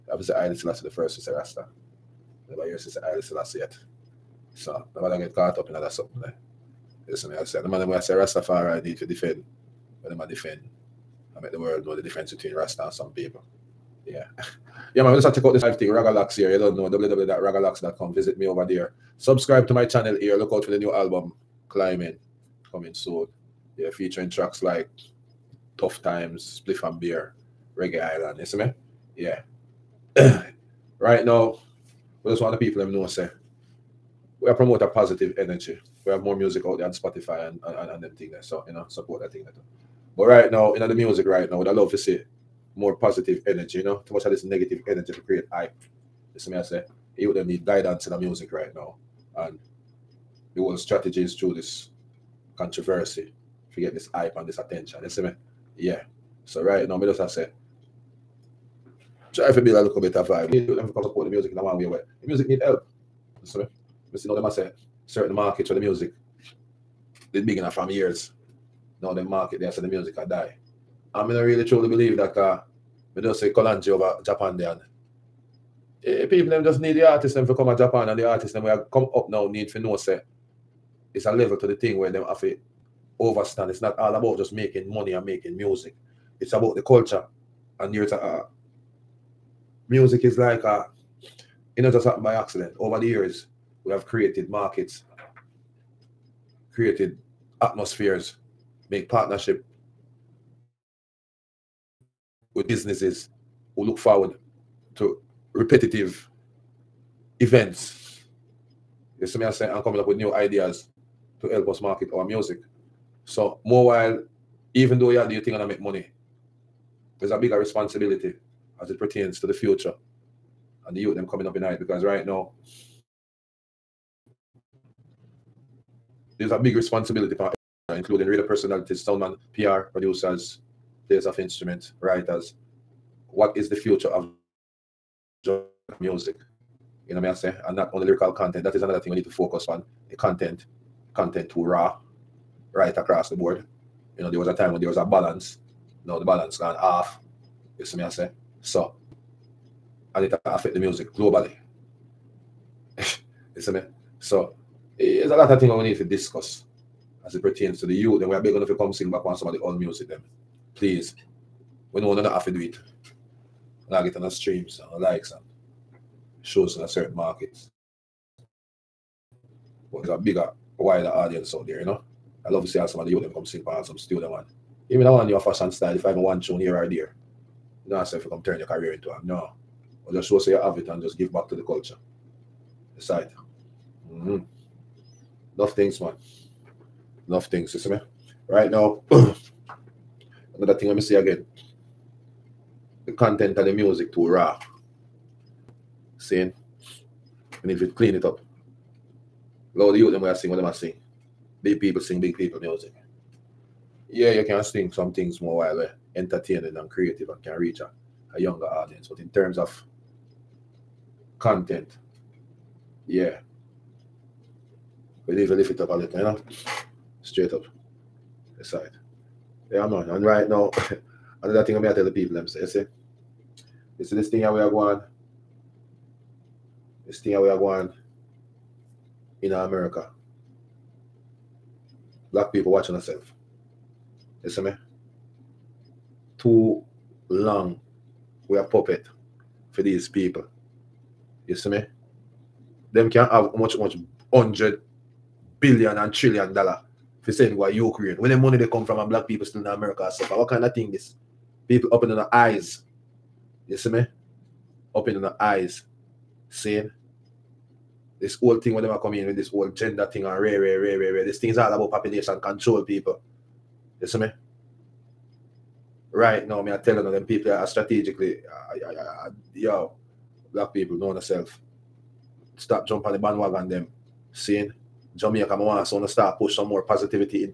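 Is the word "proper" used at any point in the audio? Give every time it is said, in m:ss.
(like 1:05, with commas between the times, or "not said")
not said.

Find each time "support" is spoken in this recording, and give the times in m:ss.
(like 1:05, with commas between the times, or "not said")
0:38, 1:01.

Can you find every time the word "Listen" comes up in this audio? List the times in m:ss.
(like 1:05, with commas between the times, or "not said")
0:07, 0:46.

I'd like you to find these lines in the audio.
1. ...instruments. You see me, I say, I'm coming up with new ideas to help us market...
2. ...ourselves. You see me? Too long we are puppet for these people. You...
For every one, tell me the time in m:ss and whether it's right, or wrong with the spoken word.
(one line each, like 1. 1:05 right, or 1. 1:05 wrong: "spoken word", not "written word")
1. 1:47 wrong: "events", not "instruments"
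2. 3:52 right.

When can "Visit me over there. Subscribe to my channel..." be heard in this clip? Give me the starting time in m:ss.
0:18.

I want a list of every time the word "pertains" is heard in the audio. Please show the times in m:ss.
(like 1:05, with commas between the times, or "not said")
1:58, 2:37.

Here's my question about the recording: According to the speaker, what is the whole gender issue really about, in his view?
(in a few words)
Population control.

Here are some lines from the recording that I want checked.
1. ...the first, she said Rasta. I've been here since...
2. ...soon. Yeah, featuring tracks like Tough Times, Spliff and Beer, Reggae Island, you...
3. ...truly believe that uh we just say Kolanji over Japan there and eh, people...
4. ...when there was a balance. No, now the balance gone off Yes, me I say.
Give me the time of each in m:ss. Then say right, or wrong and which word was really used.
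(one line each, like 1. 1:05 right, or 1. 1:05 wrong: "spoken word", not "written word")
1. 0:00 right
2. 0:22 right
3. 1:11 right
4. 2:24 right.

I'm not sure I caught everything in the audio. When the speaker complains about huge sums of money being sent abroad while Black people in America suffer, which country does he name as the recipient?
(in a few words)
Ukraine.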